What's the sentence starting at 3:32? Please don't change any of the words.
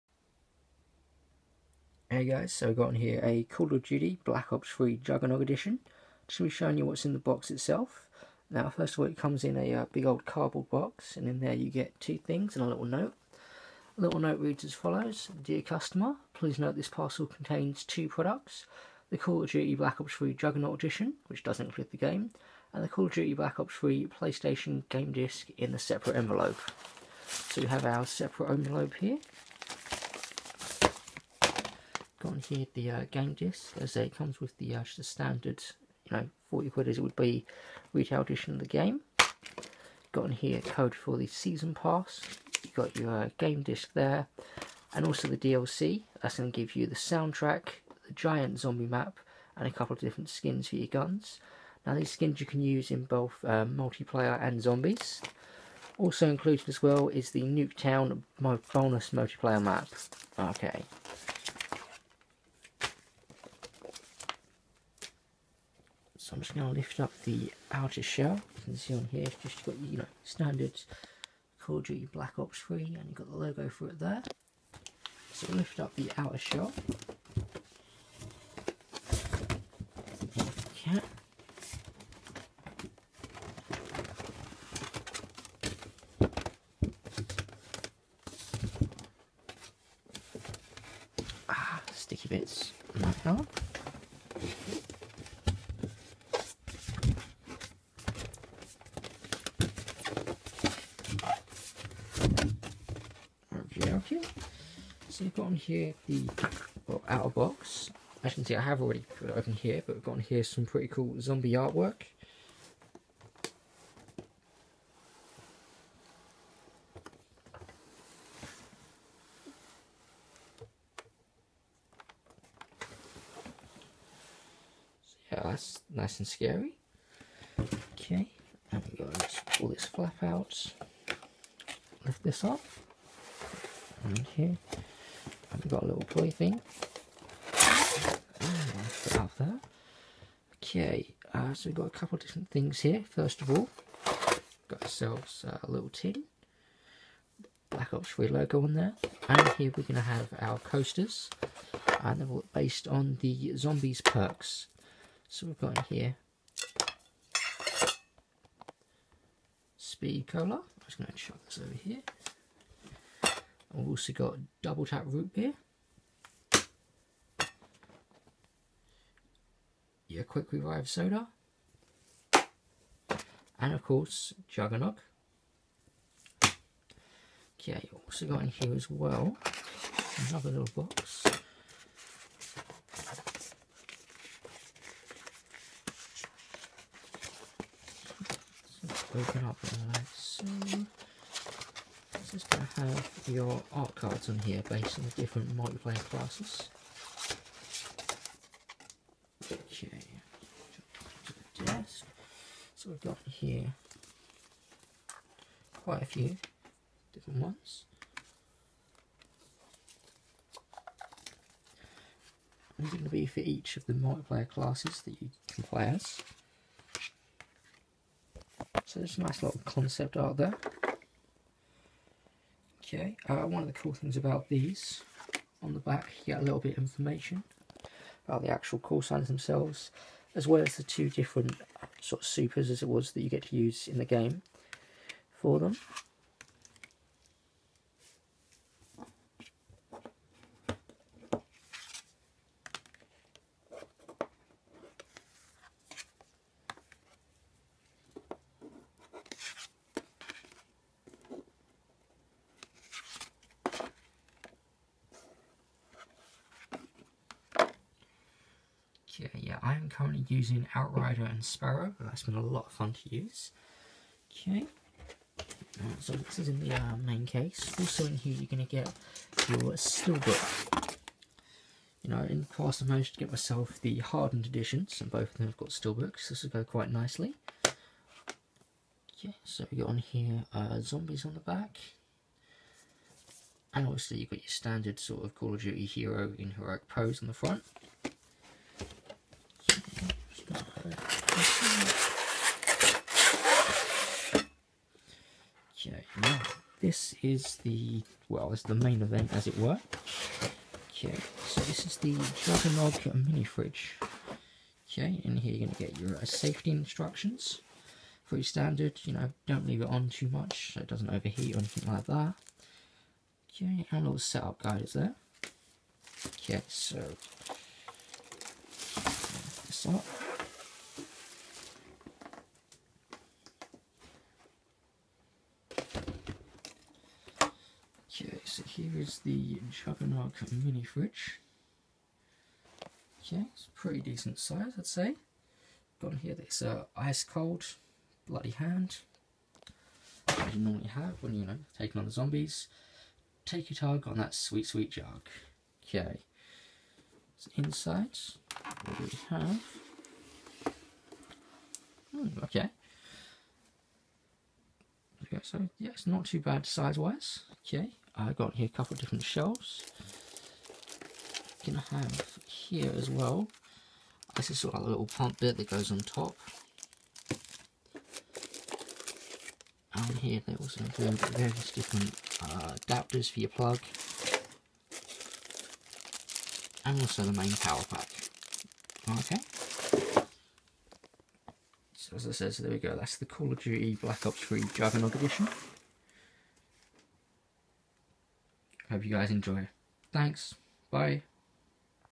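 These are going to be for each of the multiplayer classes that you can play as.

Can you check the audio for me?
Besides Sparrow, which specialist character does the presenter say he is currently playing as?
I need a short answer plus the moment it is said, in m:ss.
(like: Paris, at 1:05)
Outrider, at 4:20.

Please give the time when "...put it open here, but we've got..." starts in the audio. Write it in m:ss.
1:49.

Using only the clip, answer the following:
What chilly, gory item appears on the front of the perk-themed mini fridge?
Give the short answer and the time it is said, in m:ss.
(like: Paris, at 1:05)
ice cold bloody hand, at 5:36.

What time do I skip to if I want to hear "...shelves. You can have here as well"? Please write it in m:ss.
5:59.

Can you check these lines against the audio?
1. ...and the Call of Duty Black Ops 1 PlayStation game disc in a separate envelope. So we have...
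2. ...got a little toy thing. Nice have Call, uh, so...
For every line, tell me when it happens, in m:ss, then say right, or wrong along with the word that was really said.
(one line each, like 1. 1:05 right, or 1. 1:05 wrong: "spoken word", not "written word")
1. 0:22 wrong: "3", not "1"
2. 2:15 wrong: "Okay", not "Call".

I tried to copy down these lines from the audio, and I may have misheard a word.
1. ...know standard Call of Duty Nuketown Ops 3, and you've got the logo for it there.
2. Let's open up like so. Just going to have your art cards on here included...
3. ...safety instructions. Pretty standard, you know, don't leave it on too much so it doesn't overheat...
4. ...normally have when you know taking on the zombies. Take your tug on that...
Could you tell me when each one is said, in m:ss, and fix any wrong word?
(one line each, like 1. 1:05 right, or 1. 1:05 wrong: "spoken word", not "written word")
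1. 1:09 wrong: "Black", not "Nuketown"
2. 3:08 wrong: "based", not "included"
3. 5:06 right
4. 5:40 right.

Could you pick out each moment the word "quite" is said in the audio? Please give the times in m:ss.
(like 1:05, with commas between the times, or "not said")
3:25, 4:36.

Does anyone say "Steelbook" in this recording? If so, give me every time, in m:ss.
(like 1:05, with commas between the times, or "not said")
4:29, 4:35.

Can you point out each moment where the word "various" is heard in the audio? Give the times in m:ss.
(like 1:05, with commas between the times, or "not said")
6:11.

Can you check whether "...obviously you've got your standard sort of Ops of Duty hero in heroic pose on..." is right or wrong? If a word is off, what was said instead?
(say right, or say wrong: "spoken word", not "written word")
wrong: "Call", not "Ops".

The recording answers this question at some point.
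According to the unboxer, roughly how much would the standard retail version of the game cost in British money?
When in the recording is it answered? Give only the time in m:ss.
0:36.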